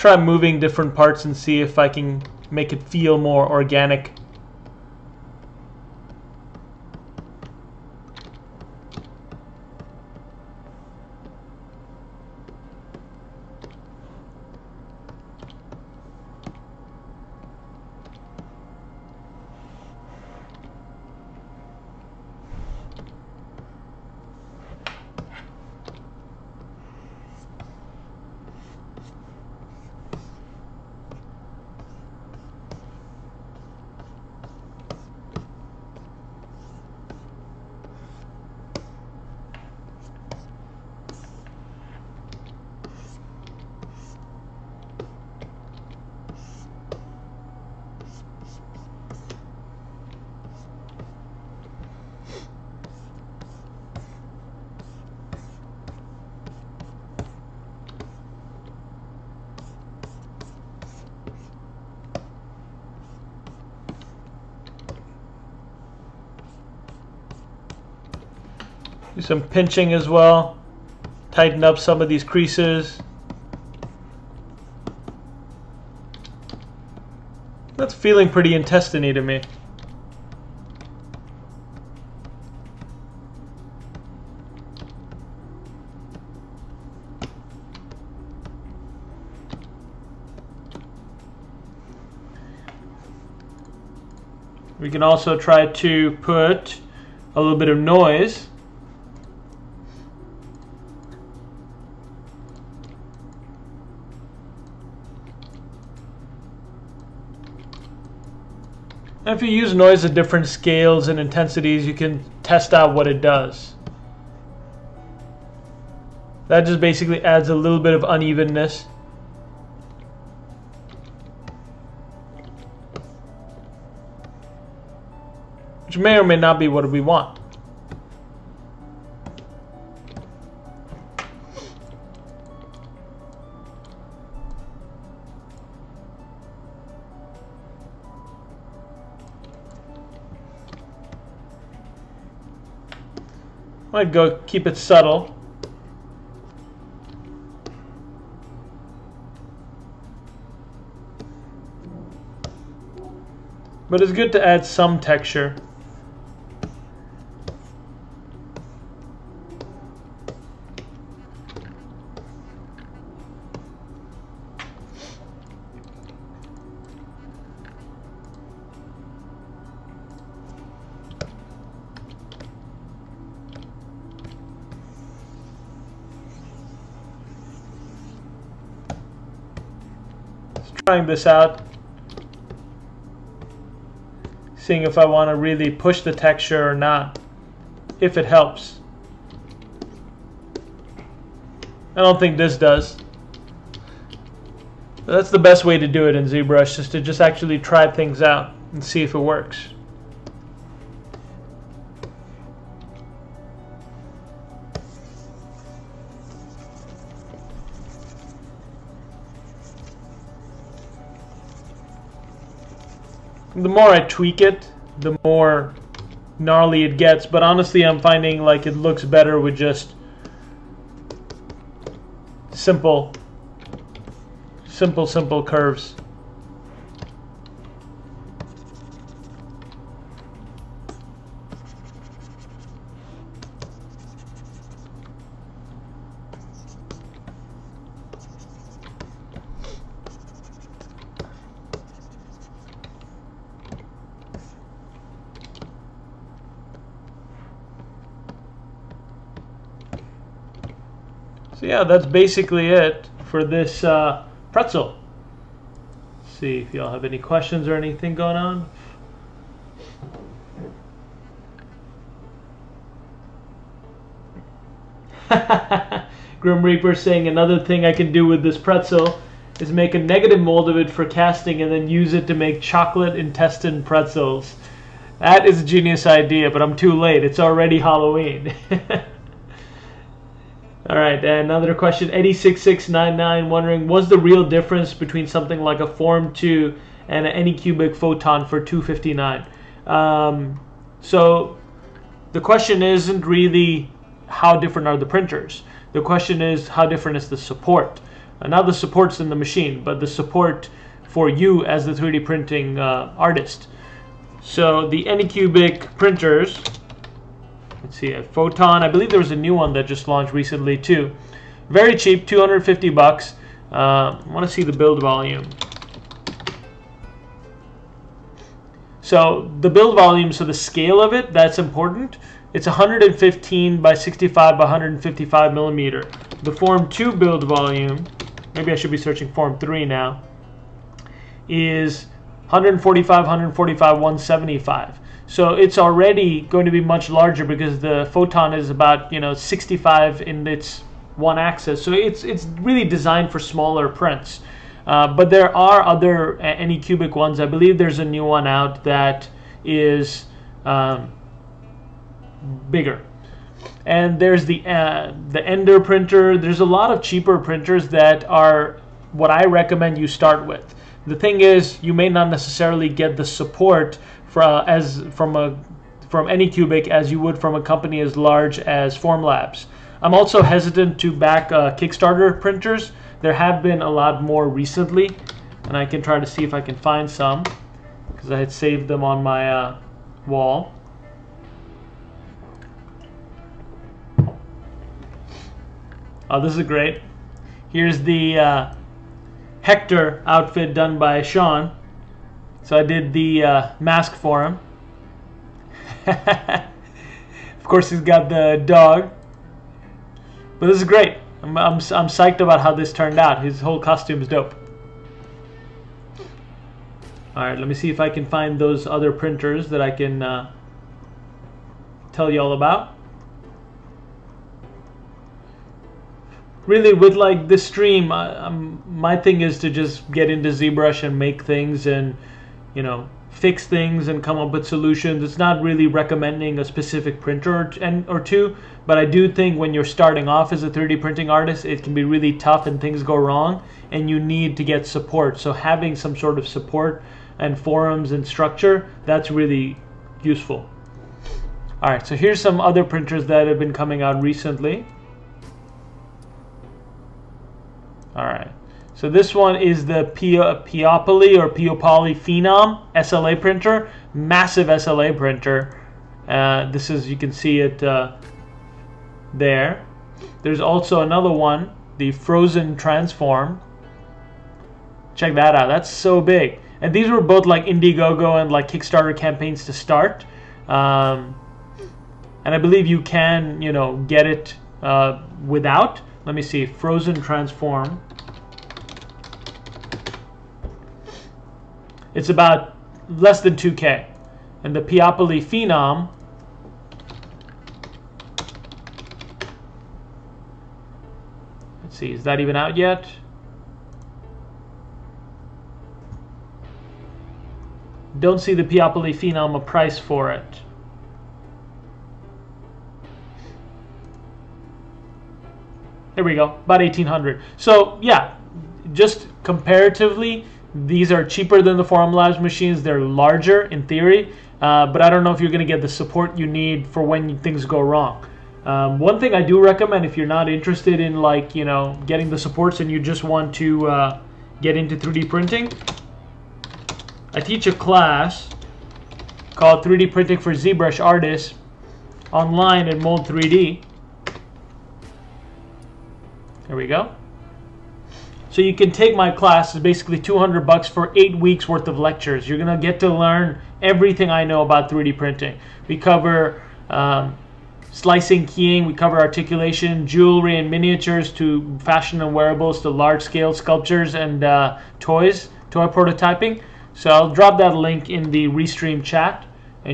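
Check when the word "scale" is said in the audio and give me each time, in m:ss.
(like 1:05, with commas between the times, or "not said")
1:50, 5:20, 9:13.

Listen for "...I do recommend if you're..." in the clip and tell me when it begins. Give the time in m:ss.
8:39.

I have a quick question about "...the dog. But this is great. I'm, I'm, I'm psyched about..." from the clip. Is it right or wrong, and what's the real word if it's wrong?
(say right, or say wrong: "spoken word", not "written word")
right.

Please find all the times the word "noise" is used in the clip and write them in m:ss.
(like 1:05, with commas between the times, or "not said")
1:37, 1:49.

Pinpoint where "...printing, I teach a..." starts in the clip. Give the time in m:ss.
8:45.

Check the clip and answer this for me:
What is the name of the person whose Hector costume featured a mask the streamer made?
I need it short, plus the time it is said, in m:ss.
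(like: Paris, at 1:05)
Sean, at 6:31.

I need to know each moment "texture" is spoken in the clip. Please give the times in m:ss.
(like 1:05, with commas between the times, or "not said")
2:35, 3:06.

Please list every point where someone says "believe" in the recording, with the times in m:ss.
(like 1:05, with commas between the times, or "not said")
5:08, 5:47, 7:52.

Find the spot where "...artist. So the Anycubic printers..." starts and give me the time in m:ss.
5:03.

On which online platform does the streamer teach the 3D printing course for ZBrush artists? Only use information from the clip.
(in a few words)
Mold3D.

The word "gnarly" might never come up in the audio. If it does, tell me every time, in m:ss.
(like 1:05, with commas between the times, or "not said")
3:36.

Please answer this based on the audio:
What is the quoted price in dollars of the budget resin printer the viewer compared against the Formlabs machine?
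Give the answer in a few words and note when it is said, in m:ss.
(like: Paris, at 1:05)
$259, at 4:48.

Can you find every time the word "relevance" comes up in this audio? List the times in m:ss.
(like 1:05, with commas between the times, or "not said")
not said.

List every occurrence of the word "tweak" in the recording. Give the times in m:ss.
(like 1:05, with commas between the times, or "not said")
3:33.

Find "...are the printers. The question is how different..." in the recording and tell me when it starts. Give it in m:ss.
4:54.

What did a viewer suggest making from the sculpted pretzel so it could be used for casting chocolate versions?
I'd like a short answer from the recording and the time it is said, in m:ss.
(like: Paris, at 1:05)
negative mold, at 4:29.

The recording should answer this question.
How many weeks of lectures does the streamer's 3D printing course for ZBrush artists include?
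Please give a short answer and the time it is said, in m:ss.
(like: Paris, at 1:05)
8, at 9:01.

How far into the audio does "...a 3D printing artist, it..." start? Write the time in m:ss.
7:10.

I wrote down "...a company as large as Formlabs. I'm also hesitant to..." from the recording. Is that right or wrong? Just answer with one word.
right.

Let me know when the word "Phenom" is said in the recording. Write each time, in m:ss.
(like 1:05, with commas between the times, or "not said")
7:32, 8:05, 8:19.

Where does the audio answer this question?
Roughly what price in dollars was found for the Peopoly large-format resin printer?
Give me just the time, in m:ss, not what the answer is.
8:26.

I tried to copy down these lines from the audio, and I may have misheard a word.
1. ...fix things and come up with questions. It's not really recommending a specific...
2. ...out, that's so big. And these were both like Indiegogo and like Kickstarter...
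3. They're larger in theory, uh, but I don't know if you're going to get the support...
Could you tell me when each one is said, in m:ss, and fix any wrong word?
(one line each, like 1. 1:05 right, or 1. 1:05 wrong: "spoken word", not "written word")
1. 7:03 wrong: "solutions", not "questions"
2. 7:45 right
3. 8:32 right.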